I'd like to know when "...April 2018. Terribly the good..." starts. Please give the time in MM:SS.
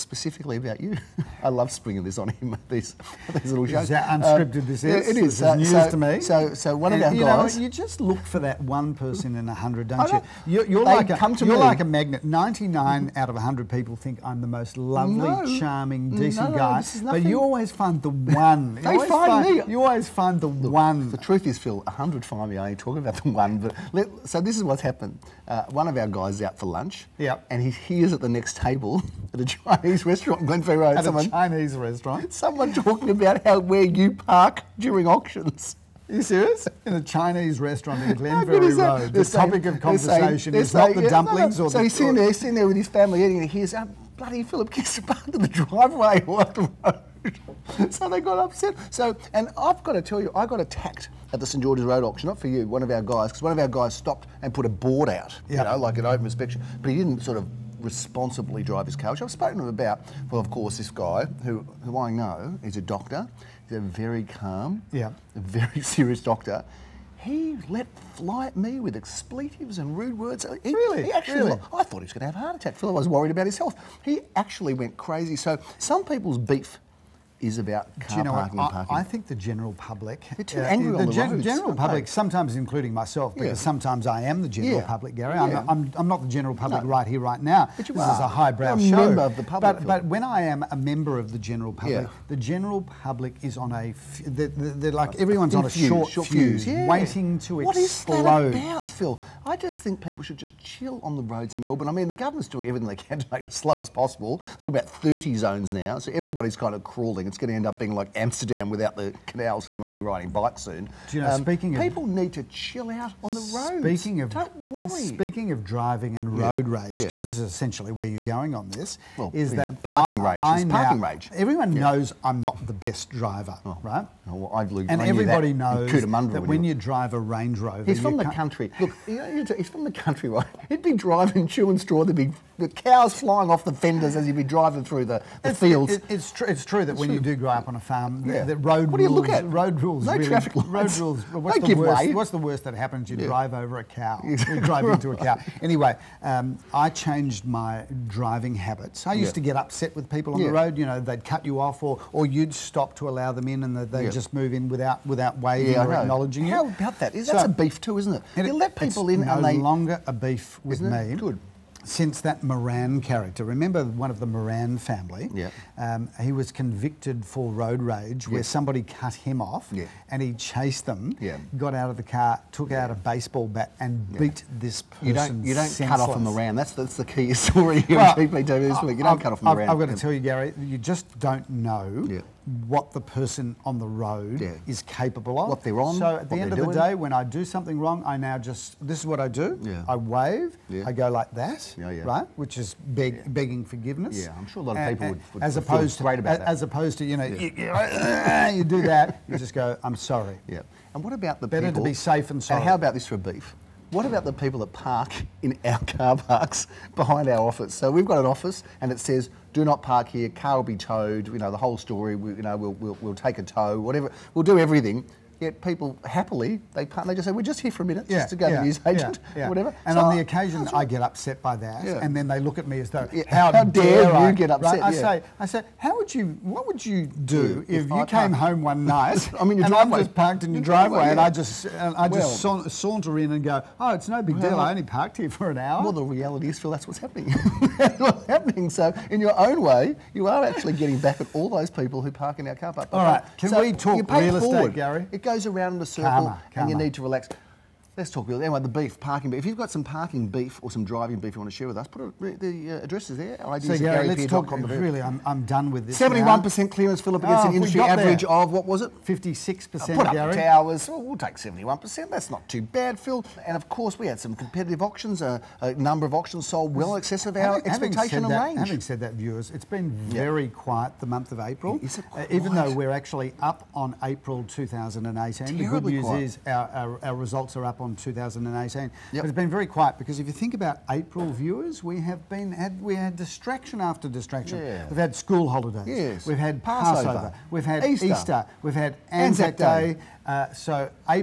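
04:34.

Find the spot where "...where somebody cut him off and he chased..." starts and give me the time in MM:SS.
02:48.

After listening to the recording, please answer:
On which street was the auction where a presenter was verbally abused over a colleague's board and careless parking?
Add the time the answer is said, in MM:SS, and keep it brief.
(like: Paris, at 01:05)
St George's Road, at 00:51.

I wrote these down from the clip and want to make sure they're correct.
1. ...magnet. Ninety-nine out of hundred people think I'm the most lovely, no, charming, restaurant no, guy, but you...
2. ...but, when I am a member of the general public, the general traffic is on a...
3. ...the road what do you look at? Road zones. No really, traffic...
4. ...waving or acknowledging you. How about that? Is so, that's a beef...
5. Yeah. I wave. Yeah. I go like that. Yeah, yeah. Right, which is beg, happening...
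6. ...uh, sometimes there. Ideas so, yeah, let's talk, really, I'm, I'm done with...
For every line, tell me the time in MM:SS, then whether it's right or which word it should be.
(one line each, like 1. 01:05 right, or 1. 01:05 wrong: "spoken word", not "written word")
1. 00:11 wrong: "decent", not "restaurant"
2. 01:29 wrong: "public", not "traffic"
3. 02:18 wrong: "rules", not "zones"
4. 02:35 right
5. 03:09 wrong: "begging", not "happening"
6. 04:12 wrong: "addresses", not "sometimes".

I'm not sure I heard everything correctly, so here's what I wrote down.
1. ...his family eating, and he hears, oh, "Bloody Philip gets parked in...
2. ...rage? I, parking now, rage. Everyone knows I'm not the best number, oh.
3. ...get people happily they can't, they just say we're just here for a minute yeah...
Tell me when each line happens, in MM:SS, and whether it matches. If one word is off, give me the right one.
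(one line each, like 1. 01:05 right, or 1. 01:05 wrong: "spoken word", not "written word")
1. 00:42 right
2. 02:00 wrong: "driver", not "number"
3. 03:35 right.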